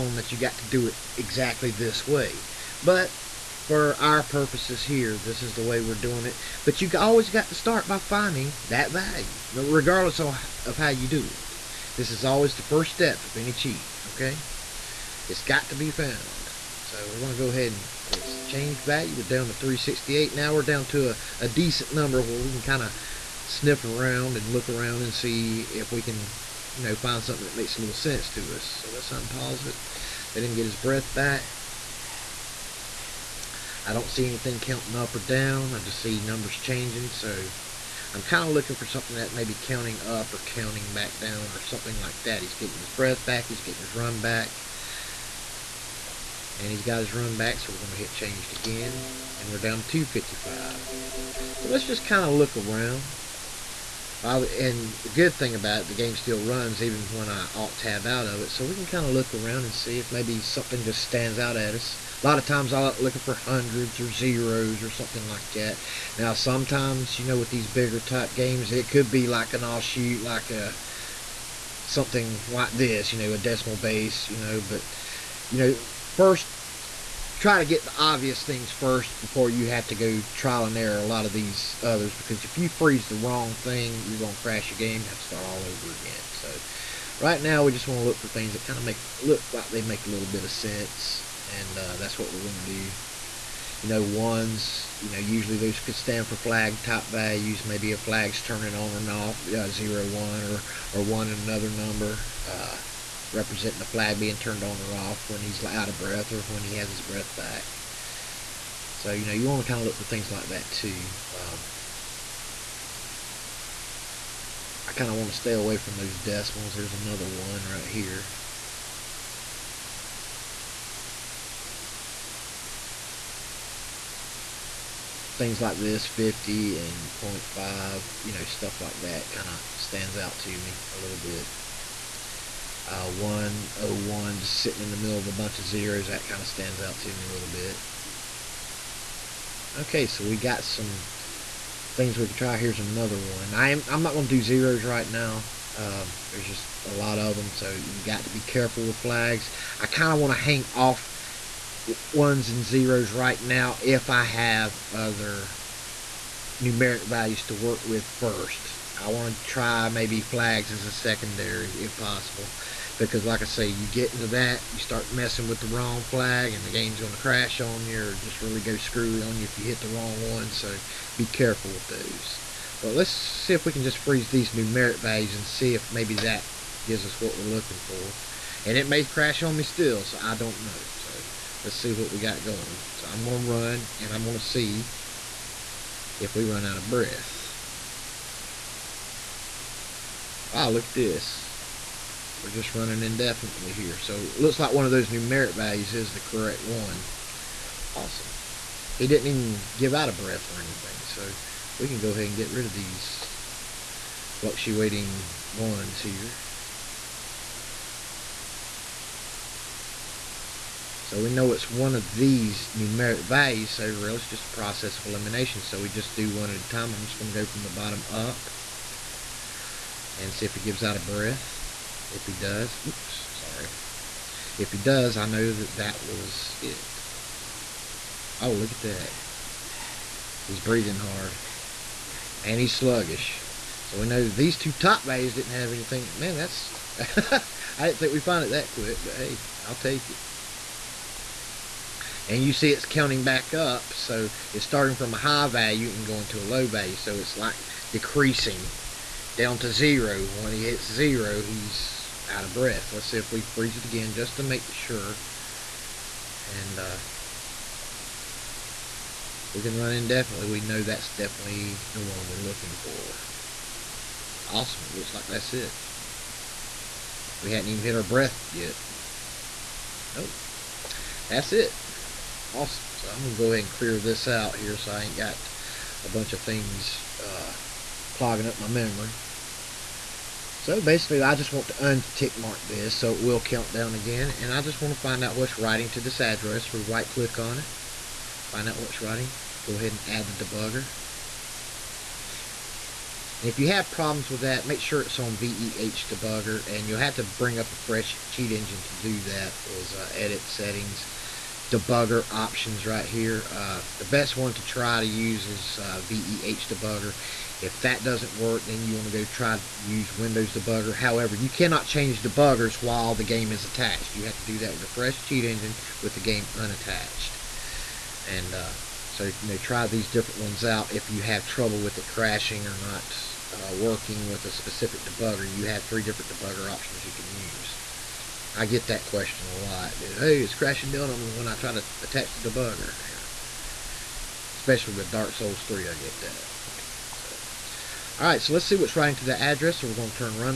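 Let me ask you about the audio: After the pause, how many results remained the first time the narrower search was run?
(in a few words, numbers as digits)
368.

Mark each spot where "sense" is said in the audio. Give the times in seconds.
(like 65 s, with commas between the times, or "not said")
27 s, 90 s.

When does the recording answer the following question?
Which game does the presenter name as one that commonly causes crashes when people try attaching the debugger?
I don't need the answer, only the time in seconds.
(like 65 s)
335 s.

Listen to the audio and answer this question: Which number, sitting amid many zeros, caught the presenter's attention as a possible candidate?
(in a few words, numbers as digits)
101.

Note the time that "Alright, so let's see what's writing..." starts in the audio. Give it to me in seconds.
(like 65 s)
338 s.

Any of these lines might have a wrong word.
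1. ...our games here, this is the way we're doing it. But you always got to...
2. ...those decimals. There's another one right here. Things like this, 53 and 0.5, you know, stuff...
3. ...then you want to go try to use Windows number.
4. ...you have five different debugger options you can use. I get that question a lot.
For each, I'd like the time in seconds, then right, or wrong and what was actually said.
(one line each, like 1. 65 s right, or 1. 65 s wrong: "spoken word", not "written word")
1. 3 s wrong: "purposes", not "games"
2. 115 s wrong: "50", not "53"
3. 308 s wrong: "debugger", not "number"
4. 325 s wrong: "three", not "five".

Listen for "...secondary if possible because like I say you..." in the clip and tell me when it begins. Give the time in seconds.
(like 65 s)
160 s.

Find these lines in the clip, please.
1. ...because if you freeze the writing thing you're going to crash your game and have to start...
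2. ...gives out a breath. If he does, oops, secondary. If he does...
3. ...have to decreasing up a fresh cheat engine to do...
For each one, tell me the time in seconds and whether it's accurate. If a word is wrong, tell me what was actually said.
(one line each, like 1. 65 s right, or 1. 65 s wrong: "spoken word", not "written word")
1. 82 s wrong: "wrong", not "writing"
2. 220 s wrong: "sorry", not "secondary"
3. 297 s wrong: "bring", not "decreasing".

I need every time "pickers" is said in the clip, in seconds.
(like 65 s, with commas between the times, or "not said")
not said.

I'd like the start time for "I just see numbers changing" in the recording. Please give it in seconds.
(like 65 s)
35 s.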